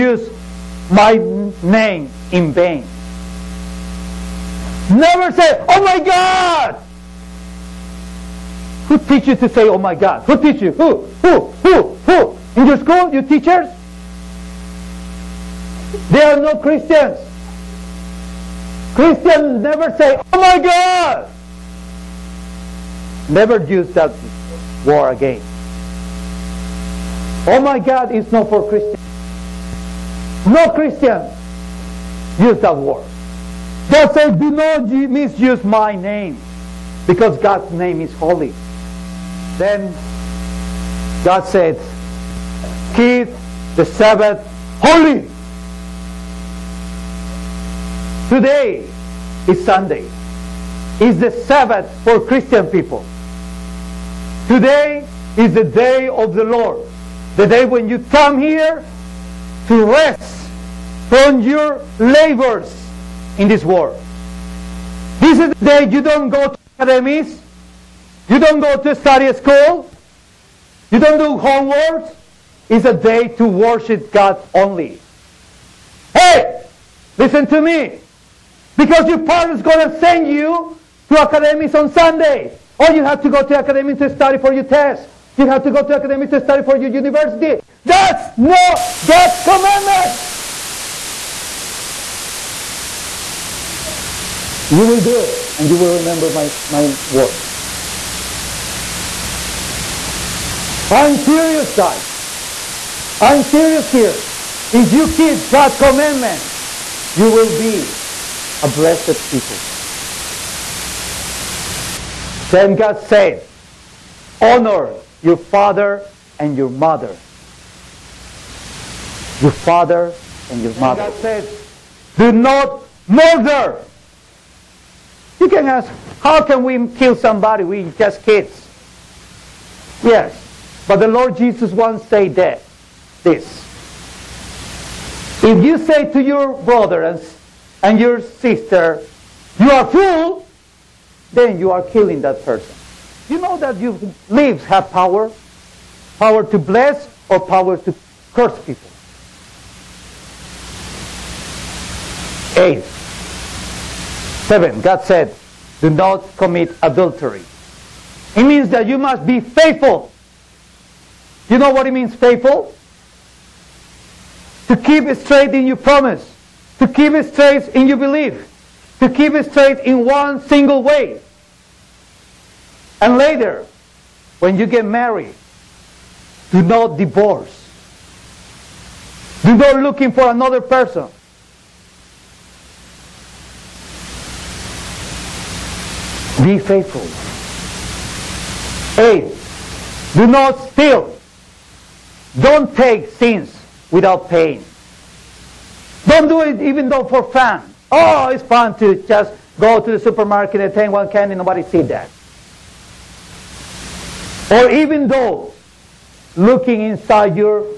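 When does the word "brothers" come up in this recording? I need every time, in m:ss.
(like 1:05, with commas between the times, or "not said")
2:16.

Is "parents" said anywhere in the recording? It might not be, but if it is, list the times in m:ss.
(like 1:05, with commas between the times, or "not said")
1:19.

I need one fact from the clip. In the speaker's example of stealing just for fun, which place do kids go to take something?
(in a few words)
supermarket.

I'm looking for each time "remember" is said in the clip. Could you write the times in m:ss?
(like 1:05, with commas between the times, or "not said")
1:35.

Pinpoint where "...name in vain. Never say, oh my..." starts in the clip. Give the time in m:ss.
0:01.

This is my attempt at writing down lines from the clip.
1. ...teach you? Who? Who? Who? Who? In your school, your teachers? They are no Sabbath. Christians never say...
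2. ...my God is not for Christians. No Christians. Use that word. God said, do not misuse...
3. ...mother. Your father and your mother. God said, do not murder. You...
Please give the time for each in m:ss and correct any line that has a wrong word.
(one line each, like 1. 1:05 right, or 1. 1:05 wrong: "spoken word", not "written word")
1. 0:10 wrong: "Christians", not "Sabbath"
2. 0:27 right
3. 1:56 right.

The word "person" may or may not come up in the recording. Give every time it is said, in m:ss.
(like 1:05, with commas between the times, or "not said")
2:22, 3:00.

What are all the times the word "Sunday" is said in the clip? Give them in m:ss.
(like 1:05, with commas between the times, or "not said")
0:49, 1:21.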